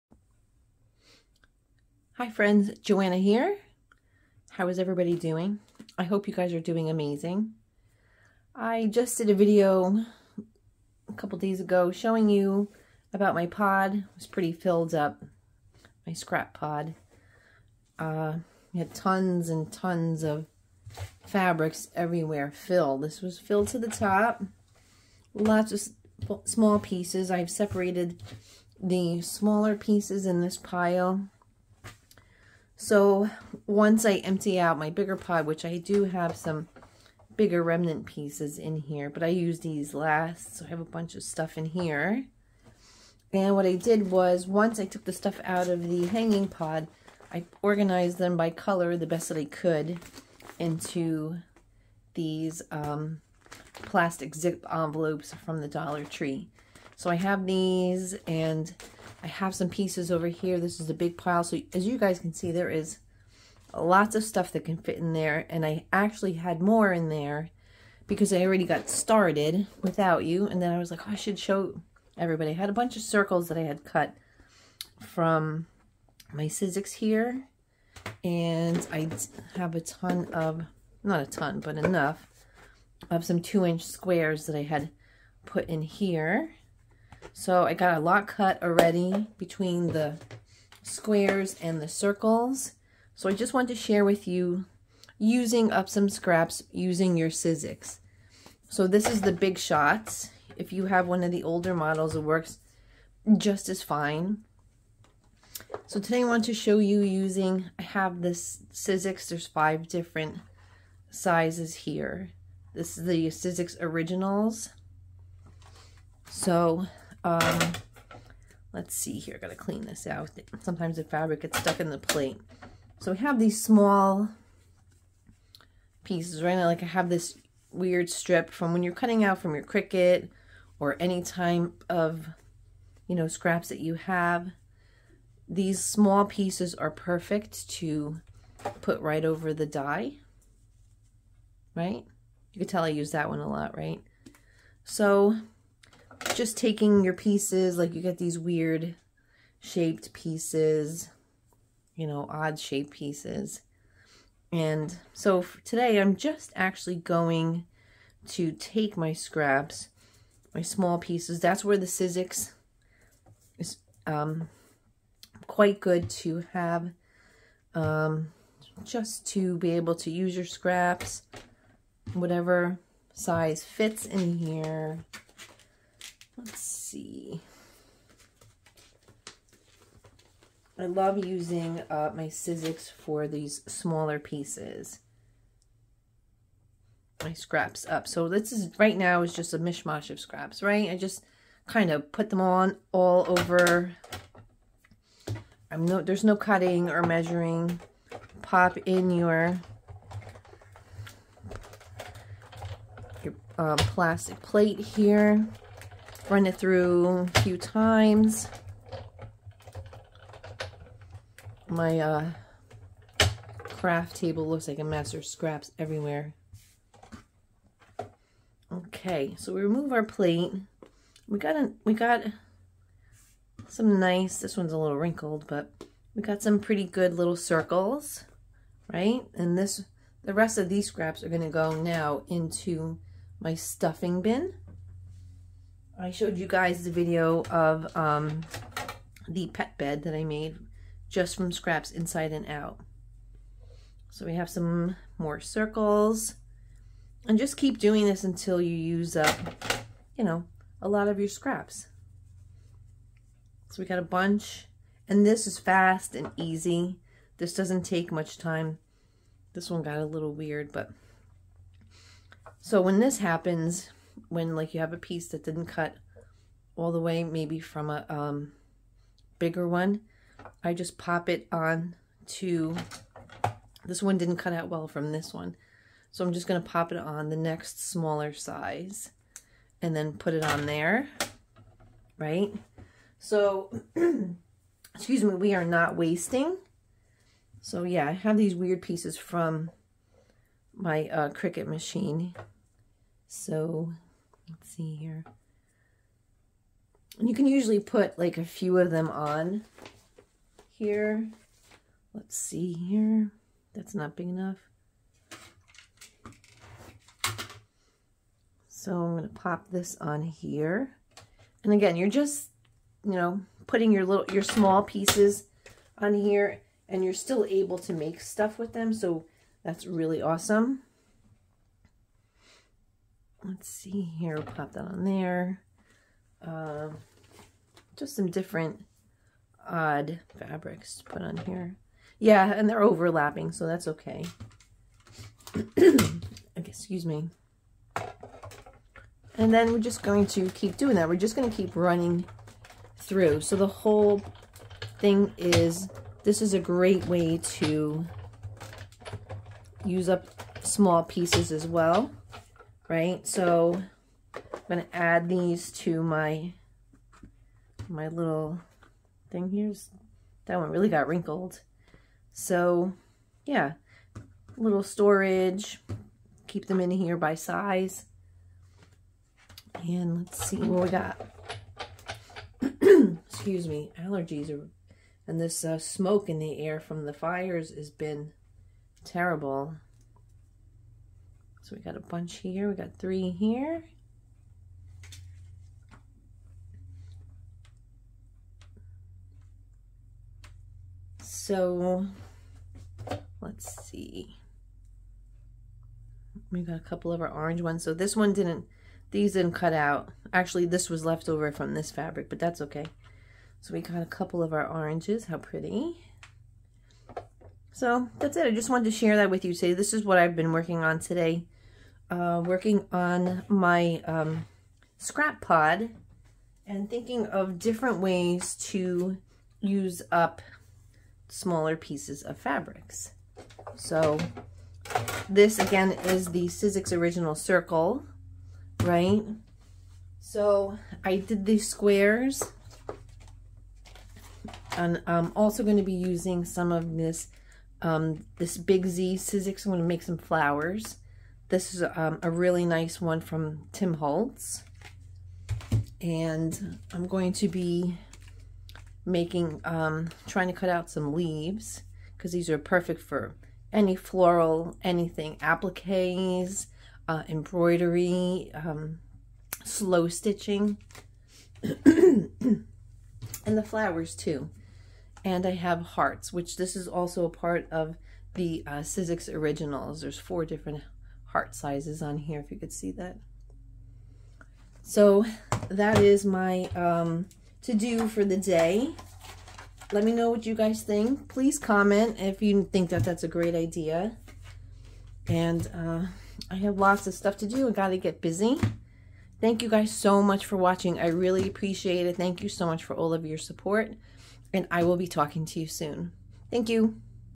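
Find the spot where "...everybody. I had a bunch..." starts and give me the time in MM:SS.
01:12.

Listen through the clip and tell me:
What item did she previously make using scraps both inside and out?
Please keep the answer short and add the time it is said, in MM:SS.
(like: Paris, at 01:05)
pet bed, at 03:59.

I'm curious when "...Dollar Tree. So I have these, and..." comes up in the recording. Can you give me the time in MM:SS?
00:55.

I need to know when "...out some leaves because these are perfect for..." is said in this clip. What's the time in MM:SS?
07:30.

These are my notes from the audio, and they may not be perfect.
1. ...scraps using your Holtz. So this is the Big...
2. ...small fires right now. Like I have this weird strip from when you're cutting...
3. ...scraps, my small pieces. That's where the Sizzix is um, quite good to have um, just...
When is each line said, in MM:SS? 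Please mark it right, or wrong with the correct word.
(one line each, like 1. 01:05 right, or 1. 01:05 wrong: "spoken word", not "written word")
1. 01:36 wrong: "Sizzix", not "Holtz"
2. 02:03 wrong: "pieces", not "fires"
3. 02:39 right.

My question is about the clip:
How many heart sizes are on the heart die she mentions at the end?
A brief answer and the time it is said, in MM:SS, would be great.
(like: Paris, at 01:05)
4, at 07:50.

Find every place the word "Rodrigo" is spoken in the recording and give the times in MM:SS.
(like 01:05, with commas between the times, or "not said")
not said.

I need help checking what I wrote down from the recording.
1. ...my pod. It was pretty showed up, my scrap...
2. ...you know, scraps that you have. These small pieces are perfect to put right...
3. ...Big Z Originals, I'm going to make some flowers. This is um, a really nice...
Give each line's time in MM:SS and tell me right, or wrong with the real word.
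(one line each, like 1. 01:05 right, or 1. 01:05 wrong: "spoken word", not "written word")
1. 00:13 wrong: "filled", not "showed"
2. 02:13 right
3. 07:18 wrong: "Sizzix", not "Originals".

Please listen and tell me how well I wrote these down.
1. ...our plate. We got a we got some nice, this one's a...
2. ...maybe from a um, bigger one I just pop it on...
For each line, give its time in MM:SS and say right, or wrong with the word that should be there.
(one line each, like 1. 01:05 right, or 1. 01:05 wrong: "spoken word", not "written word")
1. 03:39 right
2. 04:27 right.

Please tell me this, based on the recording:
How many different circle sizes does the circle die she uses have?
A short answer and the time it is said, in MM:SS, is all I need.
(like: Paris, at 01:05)
5, at 01:49.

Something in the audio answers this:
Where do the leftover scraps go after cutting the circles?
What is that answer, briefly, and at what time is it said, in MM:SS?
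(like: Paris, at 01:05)
stuffing bin, at 03:53.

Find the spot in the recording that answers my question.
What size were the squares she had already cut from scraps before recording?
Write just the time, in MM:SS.
01:23.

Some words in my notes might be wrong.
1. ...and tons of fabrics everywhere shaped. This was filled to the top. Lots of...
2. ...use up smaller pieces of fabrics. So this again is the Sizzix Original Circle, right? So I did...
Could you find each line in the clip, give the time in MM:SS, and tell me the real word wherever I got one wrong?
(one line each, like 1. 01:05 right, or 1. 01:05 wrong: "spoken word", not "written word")
1. 00:19 wrong: "filled", not "shaped"
2. 06:59 right.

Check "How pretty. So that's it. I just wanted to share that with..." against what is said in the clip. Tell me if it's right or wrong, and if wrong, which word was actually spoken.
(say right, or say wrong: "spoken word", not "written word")
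right.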